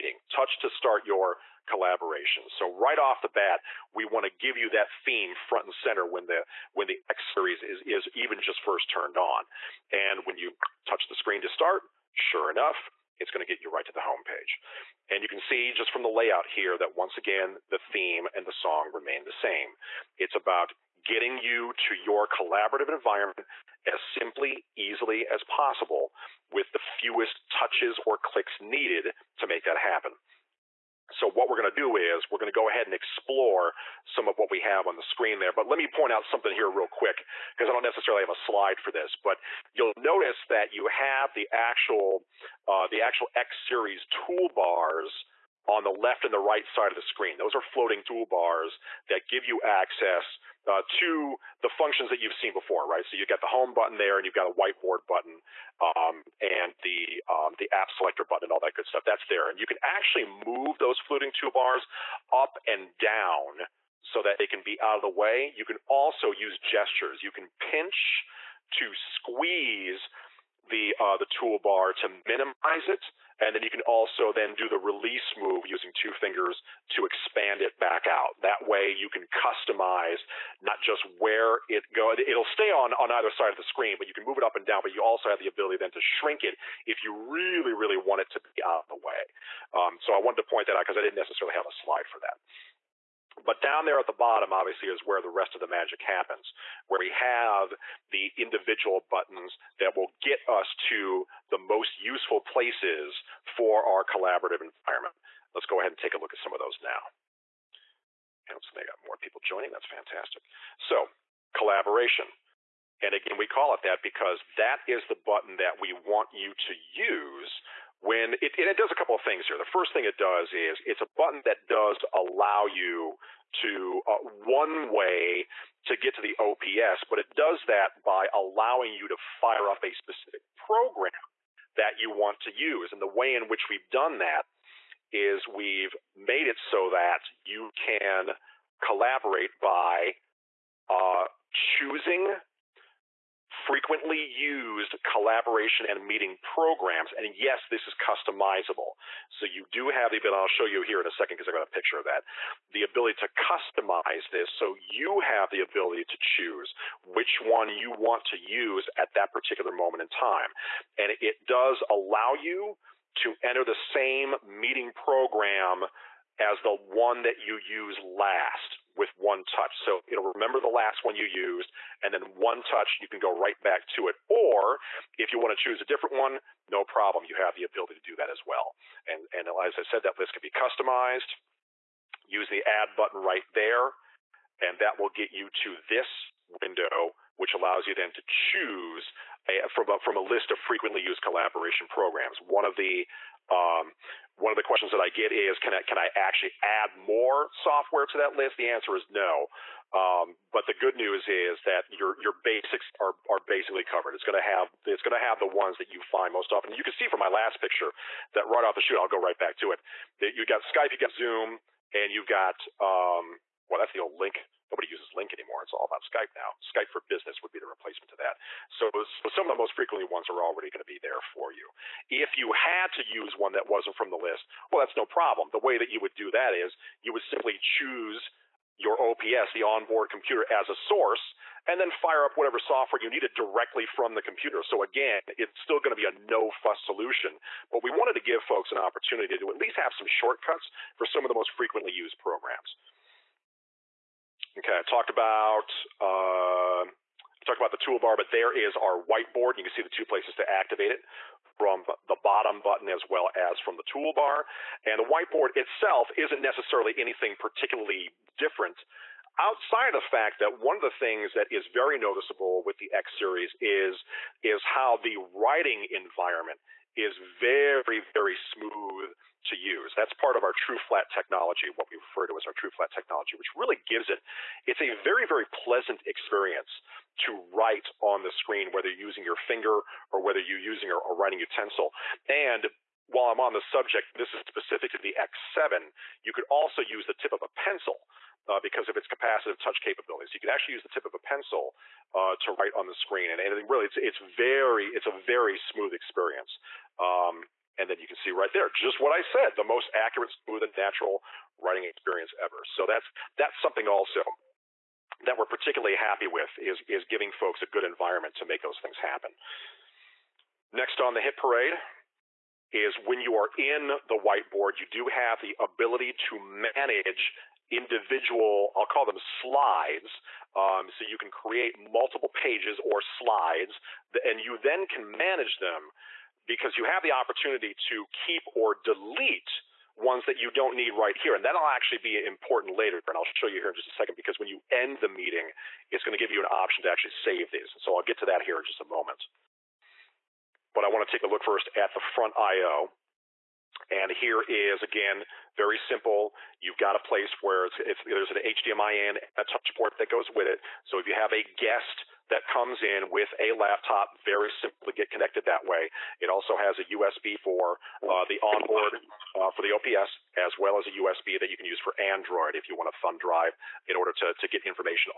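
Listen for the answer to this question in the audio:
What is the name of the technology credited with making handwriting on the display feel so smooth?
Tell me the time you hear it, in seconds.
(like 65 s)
272 s.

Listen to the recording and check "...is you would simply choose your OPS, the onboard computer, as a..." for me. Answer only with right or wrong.
right.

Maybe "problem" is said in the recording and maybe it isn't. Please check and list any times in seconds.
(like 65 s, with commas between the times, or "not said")
176 s, 225 s.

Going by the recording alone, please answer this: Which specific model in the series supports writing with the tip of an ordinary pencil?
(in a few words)
X7.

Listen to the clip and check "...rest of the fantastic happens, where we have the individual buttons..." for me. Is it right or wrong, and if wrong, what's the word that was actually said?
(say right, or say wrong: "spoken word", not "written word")
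wrong: "magic", not "fantastic".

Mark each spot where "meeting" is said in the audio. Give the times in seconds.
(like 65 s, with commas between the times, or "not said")
146 s, 164 s, 335 s.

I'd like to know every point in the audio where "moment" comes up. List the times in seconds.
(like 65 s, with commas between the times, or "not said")
159 s, 338 s.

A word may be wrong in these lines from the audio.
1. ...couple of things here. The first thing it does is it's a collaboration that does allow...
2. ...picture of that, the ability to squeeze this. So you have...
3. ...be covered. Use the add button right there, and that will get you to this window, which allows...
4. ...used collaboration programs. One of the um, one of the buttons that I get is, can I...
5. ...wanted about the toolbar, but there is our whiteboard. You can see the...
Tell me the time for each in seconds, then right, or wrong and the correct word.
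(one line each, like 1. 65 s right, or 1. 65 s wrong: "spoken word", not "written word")
1. 118 s wrong: "button", not "collaboration"
2. 151 s wrong: "customize", not "squeeze"
3. 180 s wrong: "customized", not "covered"
4. 191 s wrong: "questions", not "buttons"
5. 247 s wrong: "talked", not "wanted".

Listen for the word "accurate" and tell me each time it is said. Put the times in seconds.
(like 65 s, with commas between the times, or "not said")
299 s.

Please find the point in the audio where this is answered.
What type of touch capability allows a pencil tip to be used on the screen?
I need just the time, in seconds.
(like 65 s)
289 s.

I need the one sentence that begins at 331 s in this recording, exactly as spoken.
And that'll actually be important later.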